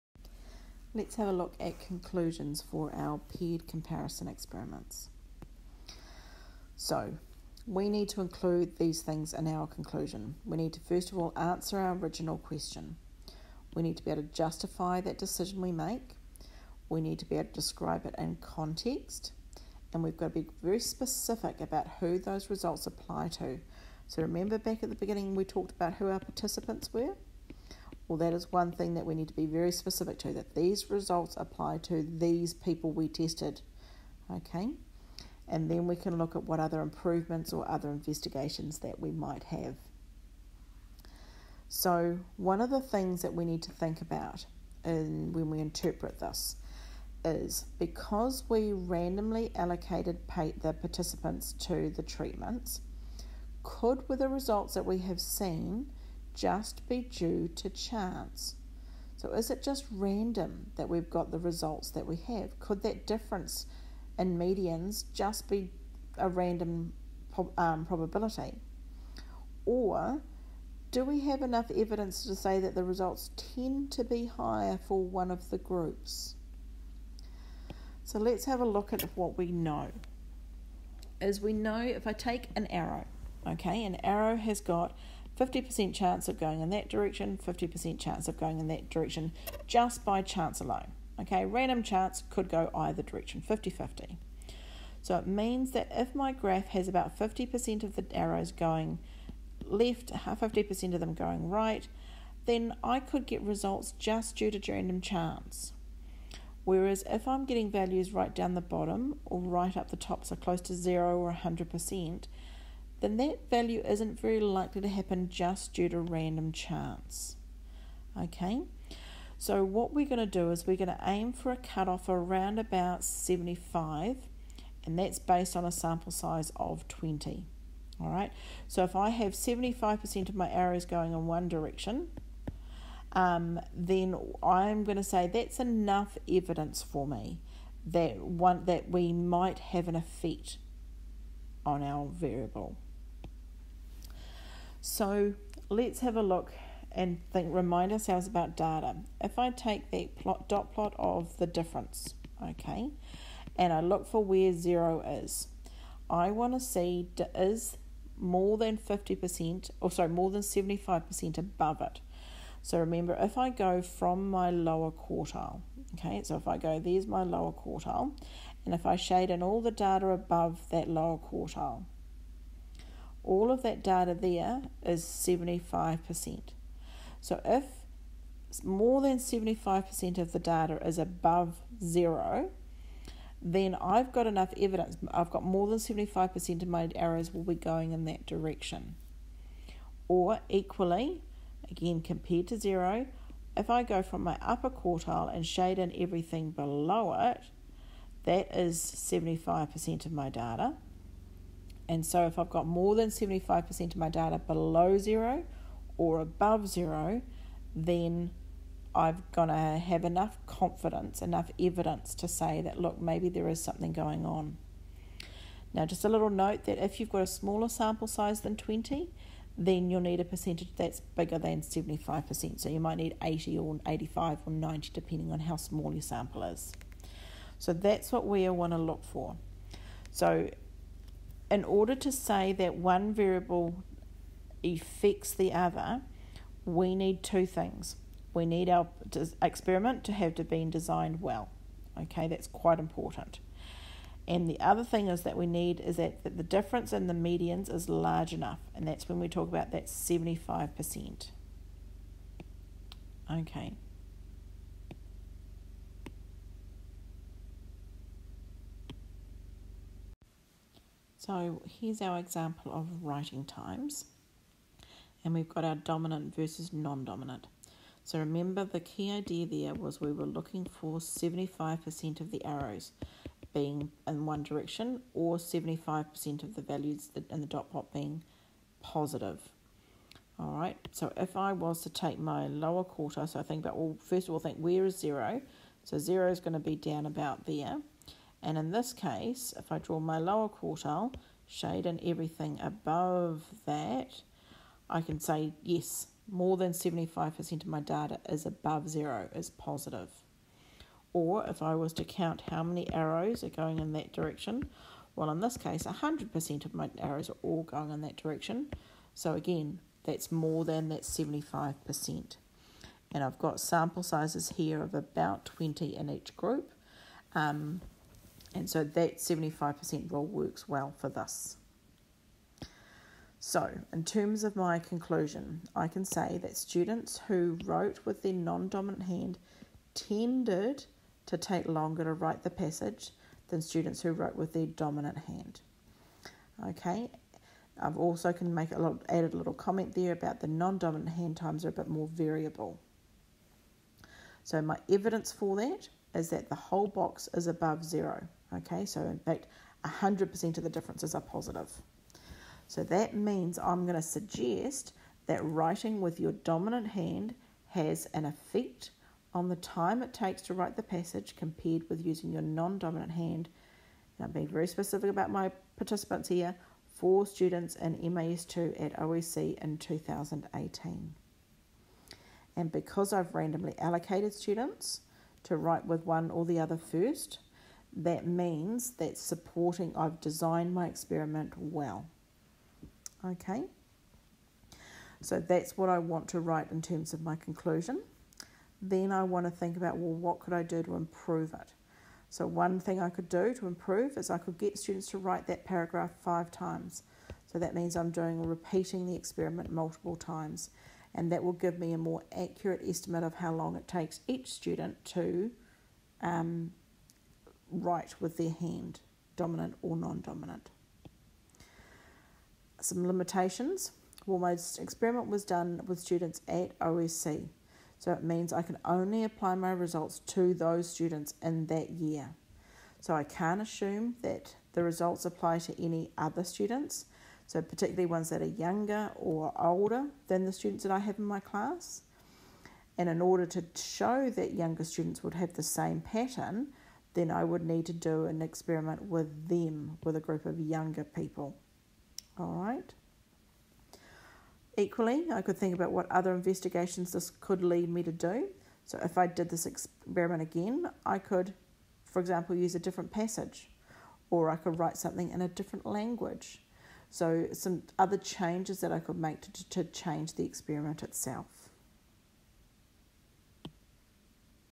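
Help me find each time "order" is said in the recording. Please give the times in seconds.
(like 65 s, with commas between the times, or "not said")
231 s, 433 s.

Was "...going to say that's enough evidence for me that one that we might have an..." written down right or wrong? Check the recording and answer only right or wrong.
right.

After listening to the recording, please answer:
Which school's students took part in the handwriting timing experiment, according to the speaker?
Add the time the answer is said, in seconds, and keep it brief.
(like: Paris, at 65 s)
OEC, at 368 s.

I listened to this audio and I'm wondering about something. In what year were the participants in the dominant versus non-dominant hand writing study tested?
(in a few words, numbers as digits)
2018.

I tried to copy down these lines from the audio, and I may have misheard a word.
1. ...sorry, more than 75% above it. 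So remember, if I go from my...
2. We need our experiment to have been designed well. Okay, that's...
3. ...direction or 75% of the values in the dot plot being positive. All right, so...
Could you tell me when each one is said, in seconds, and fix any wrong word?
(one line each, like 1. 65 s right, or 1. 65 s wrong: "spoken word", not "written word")
1. 159 s right
2. 238 s right
3. 274 s right.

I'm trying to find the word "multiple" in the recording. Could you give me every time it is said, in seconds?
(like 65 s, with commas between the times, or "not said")
399 s.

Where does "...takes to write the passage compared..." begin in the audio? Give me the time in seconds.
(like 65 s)
360 s.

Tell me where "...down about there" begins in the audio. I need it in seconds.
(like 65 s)
286 s.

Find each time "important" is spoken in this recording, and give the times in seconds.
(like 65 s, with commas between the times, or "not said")
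242 s.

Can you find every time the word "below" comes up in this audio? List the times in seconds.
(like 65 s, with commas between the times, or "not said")
196 s, 204 s.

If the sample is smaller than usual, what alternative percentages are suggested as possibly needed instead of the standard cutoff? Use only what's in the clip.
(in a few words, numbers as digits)
80 or 85 or 90.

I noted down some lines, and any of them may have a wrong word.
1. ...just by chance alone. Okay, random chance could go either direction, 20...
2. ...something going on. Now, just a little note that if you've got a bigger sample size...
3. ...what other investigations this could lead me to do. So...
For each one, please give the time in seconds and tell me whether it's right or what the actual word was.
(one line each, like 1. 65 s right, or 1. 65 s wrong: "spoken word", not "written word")
1. 89 s wrong: "50", not "20"
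2. 213 s wrong: "smaller", not "bigger"
3. 445 s right.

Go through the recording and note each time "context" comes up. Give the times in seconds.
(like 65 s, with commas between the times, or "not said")
18 s.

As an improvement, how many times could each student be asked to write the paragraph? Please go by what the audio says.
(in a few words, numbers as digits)
5 times.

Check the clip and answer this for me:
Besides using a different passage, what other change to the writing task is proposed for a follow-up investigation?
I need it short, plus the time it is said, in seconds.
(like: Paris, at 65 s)
A different language, at 455 s.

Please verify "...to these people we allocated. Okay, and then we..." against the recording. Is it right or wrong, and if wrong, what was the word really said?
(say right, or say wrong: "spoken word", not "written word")
wrong: "tested", not "allocated".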